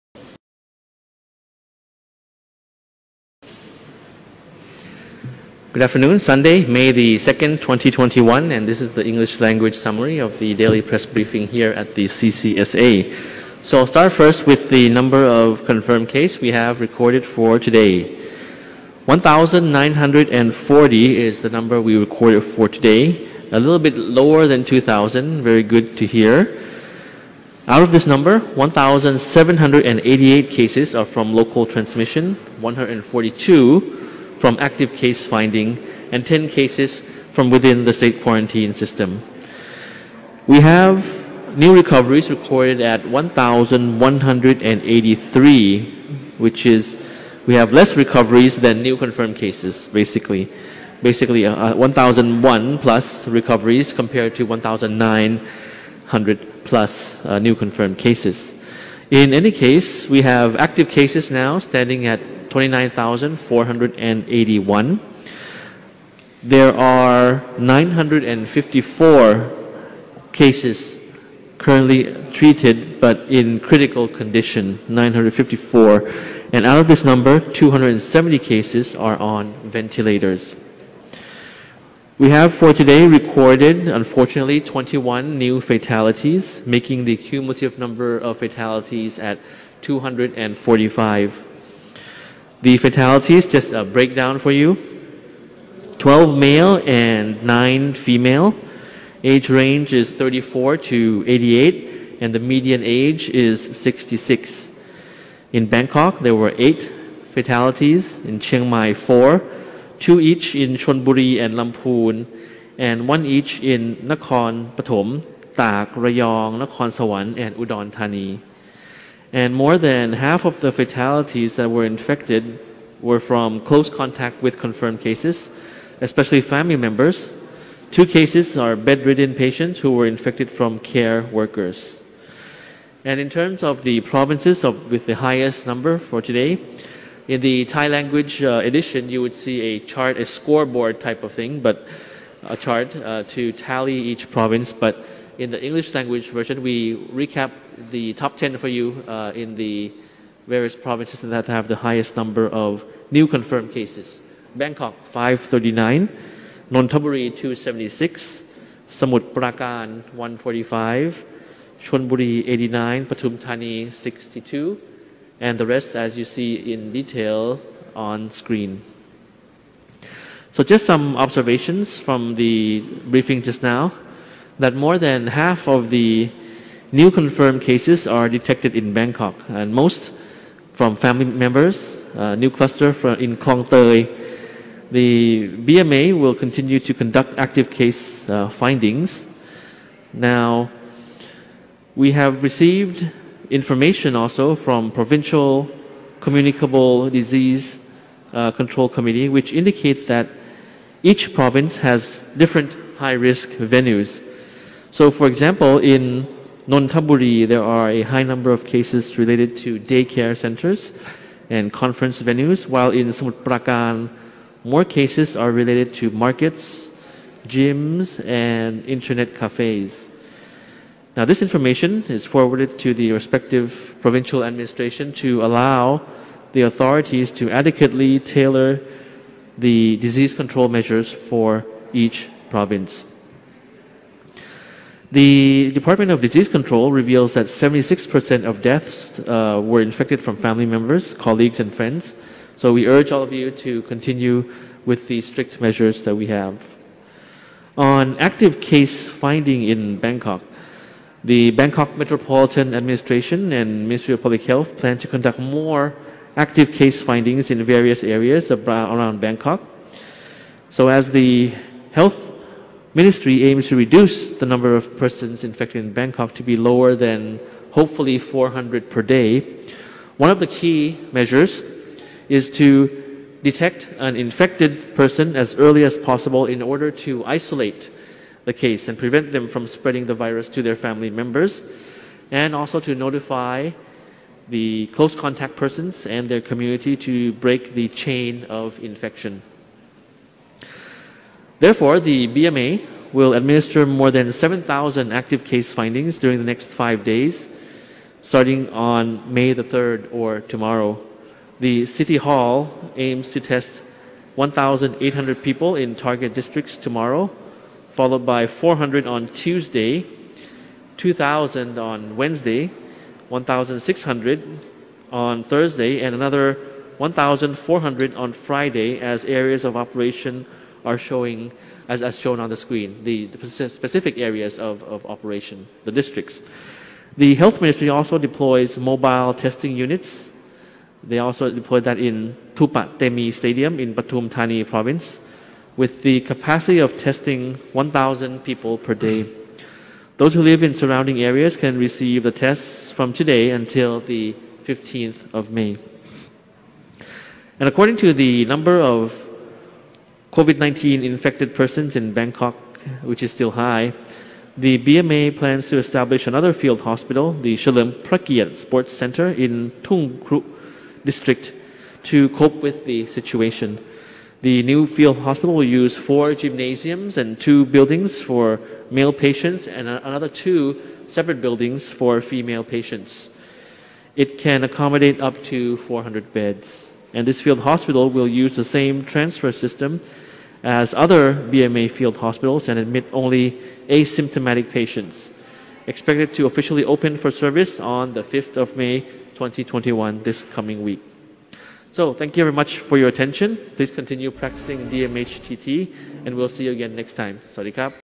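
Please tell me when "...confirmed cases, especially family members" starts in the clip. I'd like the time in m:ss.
2:04.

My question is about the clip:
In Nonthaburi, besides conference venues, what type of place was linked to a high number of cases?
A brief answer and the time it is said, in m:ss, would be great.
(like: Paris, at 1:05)
daycare centers, at 3:29.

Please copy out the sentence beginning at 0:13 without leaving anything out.
So I'll start first with the number of confirmed cases we have recorded for today.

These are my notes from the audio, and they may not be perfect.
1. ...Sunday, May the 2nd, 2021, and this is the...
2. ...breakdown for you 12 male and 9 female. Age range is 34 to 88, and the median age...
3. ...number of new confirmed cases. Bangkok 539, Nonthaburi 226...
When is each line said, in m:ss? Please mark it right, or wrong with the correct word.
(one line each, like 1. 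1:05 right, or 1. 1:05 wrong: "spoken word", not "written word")
1. 0:06 right
2. 1:33 right
3. 2:32 wrong: "276", not "226".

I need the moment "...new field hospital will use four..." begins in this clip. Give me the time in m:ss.
6:04.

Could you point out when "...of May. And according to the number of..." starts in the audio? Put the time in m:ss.
5:45.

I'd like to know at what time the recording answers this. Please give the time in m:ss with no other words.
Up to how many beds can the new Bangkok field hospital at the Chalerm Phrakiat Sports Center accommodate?
6:15.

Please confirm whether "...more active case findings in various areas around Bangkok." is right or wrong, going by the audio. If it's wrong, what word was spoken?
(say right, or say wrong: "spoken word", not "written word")
right.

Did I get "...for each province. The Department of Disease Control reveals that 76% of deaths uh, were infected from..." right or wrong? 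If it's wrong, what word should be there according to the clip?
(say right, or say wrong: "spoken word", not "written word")
right.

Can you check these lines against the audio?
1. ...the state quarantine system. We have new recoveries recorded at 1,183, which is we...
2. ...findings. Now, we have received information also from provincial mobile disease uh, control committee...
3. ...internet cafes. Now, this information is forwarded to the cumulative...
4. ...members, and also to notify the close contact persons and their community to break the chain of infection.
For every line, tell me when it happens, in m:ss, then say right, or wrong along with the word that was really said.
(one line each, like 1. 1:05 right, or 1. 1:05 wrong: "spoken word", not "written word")
1. 0:37 right
2. 3:08 wrong: "communicable", not "mobile"
3. 3:38 wrong: "respective", not "cumulative"
4. 4:41 right.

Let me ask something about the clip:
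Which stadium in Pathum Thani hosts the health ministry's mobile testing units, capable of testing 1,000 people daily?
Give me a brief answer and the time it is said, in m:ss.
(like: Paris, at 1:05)
Thupatemi Stadium, at 5:32.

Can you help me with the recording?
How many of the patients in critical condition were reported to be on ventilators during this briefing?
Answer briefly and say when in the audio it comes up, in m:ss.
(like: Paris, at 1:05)
270, at 1:17.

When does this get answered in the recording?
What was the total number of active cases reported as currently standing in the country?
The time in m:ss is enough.
1:02.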